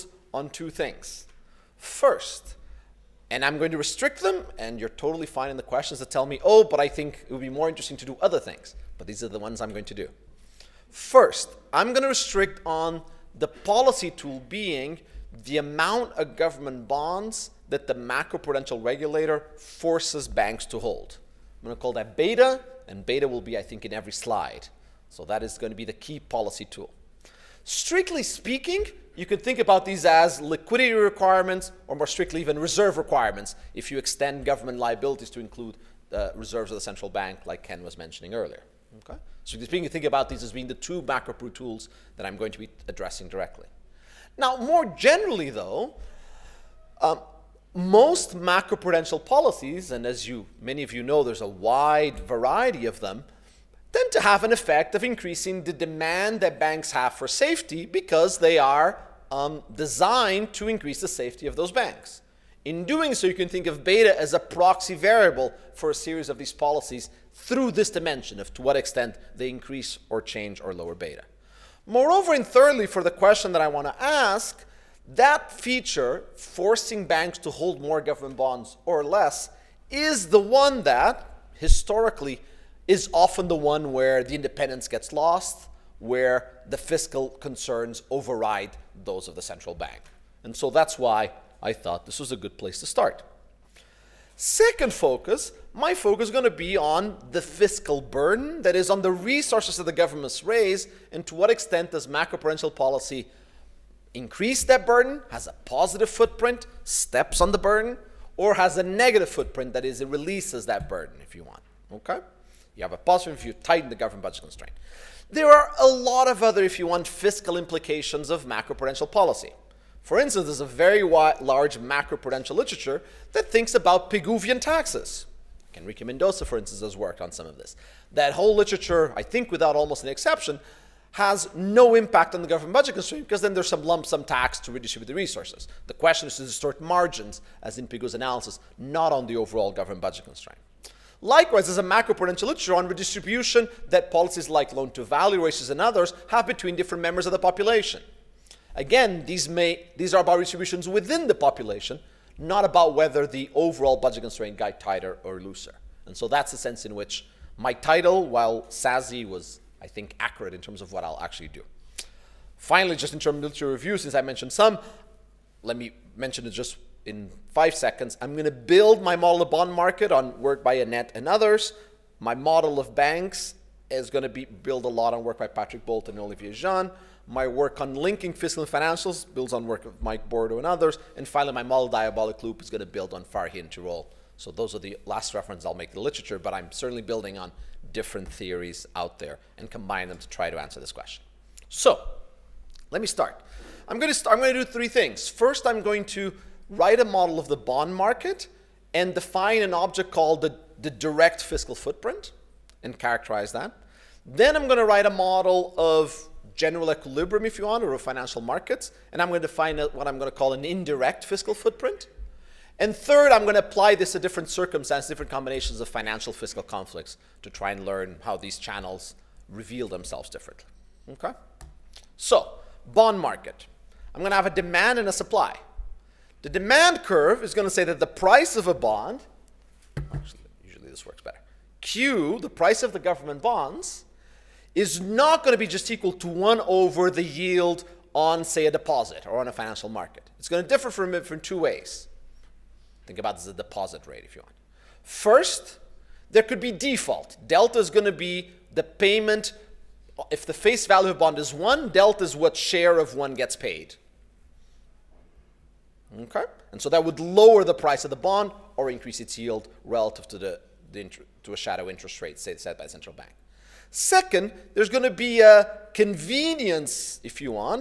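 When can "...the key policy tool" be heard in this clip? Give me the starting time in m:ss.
0:25.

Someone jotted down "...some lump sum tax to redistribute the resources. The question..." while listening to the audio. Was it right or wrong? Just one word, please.
right.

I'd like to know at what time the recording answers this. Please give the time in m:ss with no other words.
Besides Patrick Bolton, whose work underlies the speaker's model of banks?
2:56.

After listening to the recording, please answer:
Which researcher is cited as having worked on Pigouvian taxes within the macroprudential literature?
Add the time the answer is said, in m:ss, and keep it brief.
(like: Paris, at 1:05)
Enrique Mendoza, at 2:05.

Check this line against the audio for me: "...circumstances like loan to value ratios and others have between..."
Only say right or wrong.
wrong.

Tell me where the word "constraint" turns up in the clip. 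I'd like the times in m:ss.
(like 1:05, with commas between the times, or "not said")
1:54, 2:12, 2:20, 2:34.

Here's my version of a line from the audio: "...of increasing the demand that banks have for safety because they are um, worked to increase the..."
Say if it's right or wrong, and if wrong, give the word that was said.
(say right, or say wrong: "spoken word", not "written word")
wrong: "designed", not "worked".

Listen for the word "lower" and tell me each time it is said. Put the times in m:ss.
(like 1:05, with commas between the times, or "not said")
1:10, 4:17.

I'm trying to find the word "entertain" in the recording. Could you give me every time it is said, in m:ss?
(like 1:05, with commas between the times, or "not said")
not said.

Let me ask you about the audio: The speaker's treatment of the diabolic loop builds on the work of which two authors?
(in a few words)
Farhi and Tirole.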